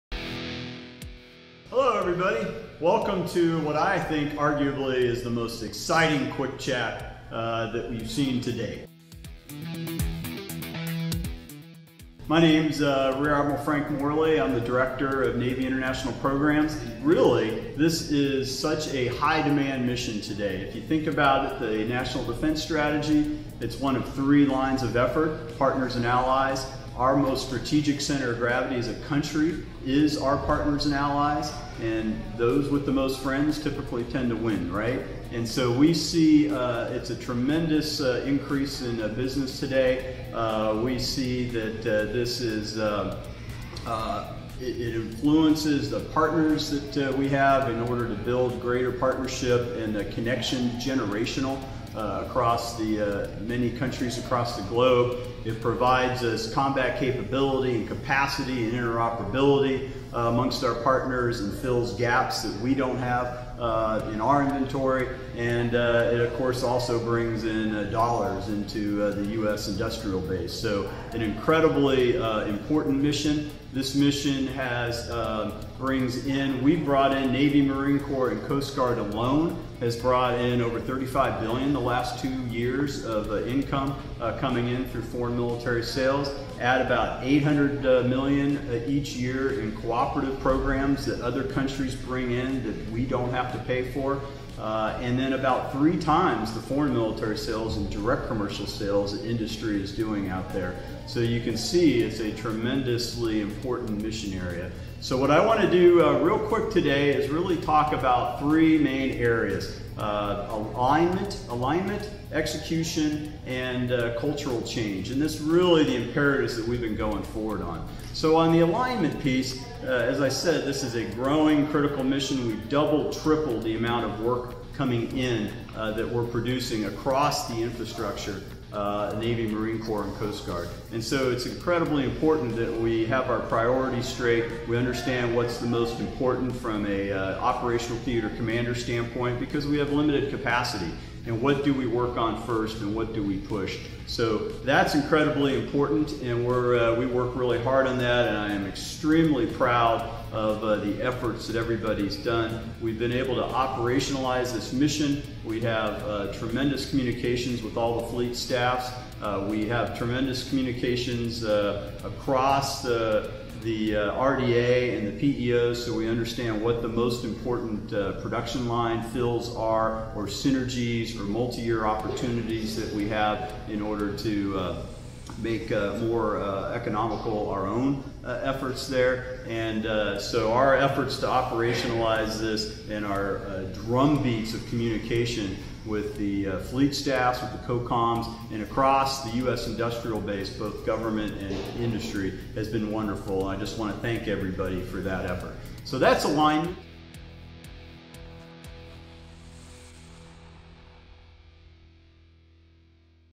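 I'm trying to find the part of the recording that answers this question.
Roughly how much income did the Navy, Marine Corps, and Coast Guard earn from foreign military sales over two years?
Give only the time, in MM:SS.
01:20.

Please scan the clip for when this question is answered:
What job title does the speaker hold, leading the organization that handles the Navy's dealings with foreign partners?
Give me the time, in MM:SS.
00:14.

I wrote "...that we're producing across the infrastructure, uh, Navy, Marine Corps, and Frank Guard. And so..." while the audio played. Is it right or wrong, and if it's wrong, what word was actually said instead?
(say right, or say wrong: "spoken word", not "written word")
wrong: "Coast", not "Frank".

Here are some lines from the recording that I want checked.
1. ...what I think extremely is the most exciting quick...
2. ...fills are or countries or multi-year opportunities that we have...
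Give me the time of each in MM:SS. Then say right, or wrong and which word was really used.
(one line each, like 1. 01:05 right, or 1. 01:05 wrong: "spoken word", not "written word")
1. 00:03 wrong: "arguably", not "extremely"
2. 02:49 wrong: "synergies", not "countries".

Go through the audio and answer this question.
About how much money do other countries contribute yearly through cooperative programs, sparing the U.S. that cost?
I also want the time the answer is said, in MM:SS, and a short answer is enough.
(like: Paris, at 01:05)
$800 million, at 01:27.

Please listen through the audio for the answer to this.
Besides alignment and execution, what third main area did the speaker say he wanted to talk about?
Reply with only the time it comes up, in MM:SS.
01:54.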